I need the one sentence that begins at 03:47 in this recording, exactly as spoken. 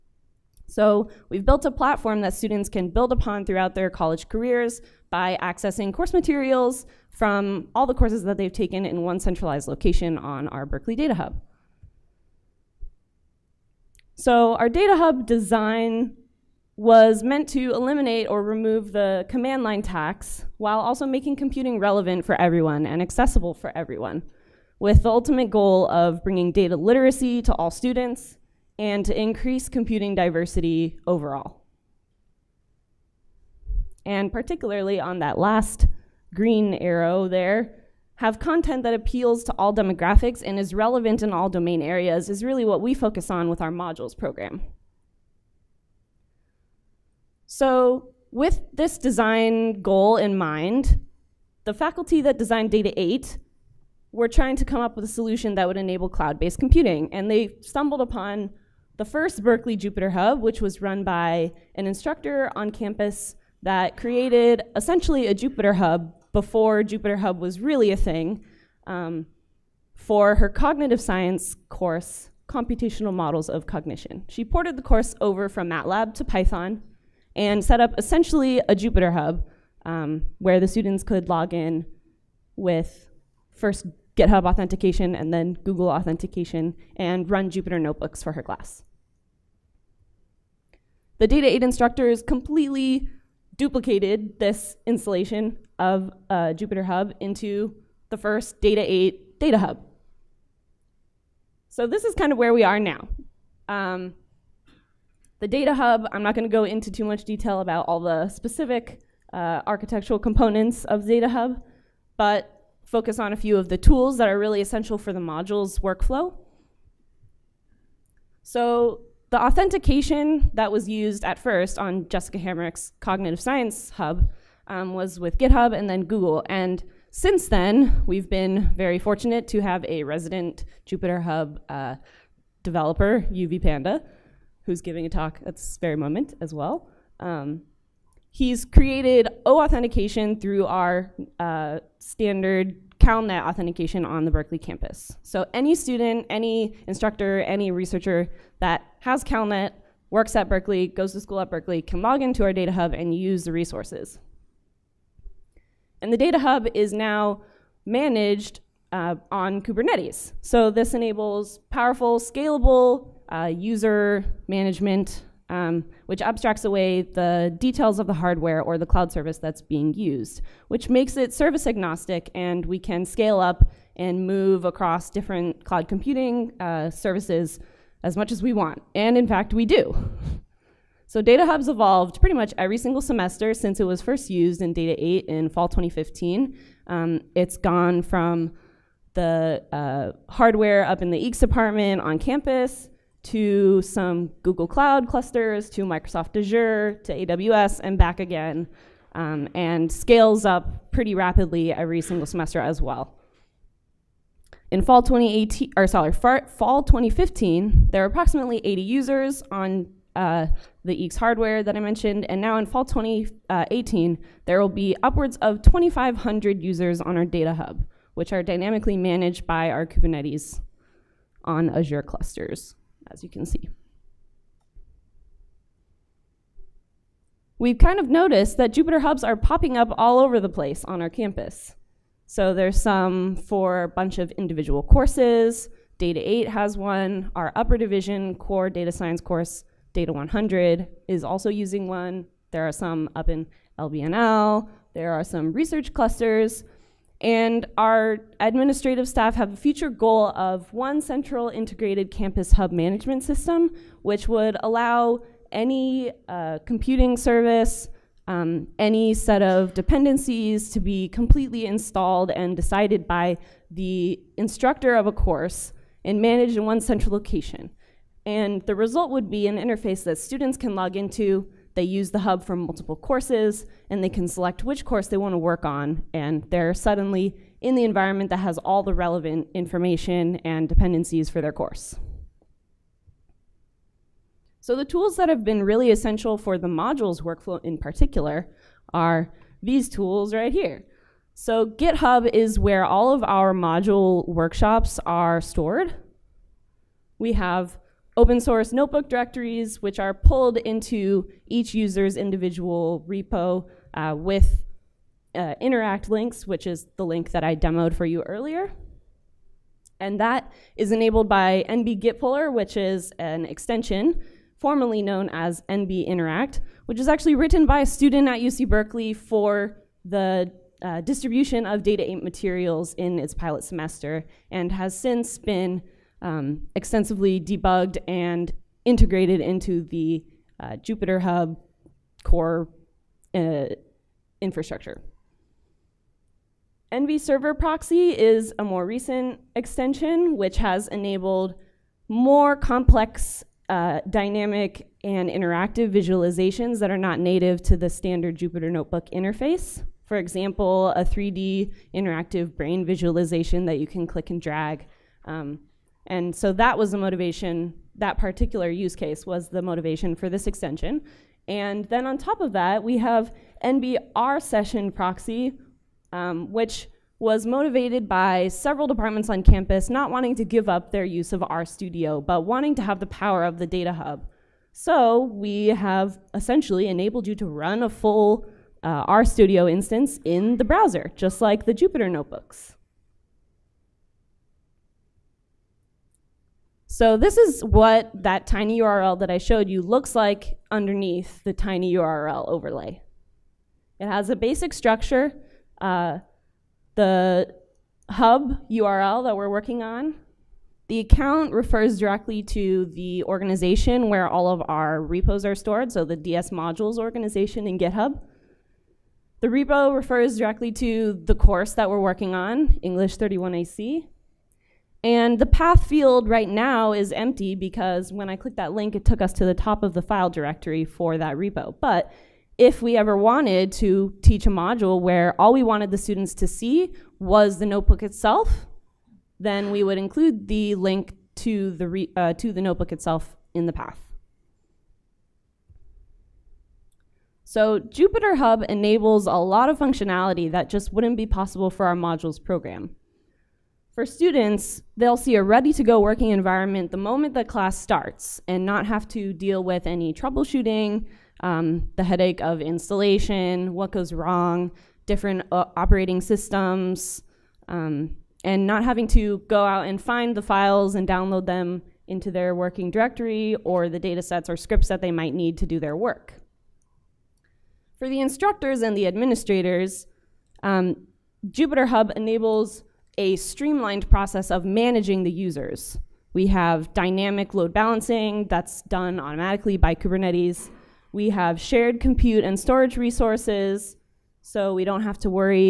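We've kind of noticed that Jupyter Hubs are popping up all over the place on our campus.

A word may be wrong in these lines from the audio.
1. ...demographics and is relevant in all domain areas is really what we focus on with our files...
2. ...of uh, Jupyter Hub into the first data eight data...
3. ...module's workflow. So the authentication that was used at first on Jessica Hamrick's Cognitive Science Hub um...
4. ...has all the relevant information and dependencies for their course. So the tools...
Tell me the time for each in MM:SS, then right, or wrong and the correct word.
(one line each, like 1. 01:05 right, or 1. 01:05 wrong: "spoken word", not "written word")
1. 00:39 wrong: "modules", not "files"
2. 01:35 right
3. 01:55 right
4. 04:38 right.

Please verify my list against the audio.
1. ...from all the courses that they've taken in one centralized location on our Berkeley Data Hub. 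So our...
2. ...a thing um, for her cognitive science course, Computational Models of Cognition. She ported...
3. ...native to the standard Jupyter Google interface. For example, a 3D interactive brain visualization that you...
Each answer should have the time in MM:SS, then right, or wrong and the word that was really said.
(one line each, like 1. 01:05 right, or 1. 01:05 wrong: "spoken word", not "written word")
1. 00:07 right
2. 01:07 right
3. 05:47 wrong: "Notebook", not "Google".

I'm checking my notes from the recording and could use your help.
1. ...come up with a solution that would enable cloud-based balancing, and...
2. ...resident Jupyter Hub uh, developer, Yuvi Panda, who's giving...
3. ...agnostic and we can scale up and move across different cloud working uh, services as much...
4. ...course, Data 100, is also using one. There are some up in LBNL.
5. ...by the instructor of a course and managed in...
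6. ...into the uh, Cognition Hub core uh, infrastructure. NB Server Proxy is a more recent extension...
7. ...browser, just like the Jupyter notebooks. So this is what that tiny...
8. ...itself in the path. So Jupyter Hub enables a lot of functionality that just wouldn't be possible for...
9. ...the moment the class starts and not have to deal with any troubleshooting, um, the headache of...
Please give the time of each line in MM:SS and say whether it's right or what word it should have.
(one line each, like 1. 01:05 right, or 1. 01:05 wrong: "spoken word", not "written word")
1. 00:54 wrong: "computing", not "balancing"
2. 02:10 right
3. 02:51 wrong: "computing", not "working"
4. 03:59 right
5. 04:23 right
6. 05:29 wrong: "Jupyter", not "Cognition"
7. 06:20 right
8. 07:12 right
9. 07:26 right.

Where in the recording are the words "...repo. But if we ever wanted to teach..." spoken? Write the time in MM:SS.
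07:01.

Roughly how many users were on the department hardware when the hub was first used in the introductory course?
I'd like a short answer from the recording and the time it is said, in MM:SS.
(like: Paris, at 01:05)
80, at 03:28.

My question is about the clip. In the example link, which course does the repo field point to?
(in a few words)
English 31AC.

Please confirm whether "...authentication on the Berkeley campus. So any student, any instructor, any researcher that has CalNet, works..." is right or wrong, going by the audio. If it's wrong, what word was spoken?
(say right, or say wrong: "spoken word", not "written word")
right.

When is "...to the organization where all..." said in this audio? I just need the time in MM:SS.
06:42.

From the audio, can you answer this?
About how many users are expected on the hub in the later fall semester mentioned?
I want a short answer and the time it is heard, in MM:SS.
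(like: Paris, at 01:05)
2,500, at 03:35.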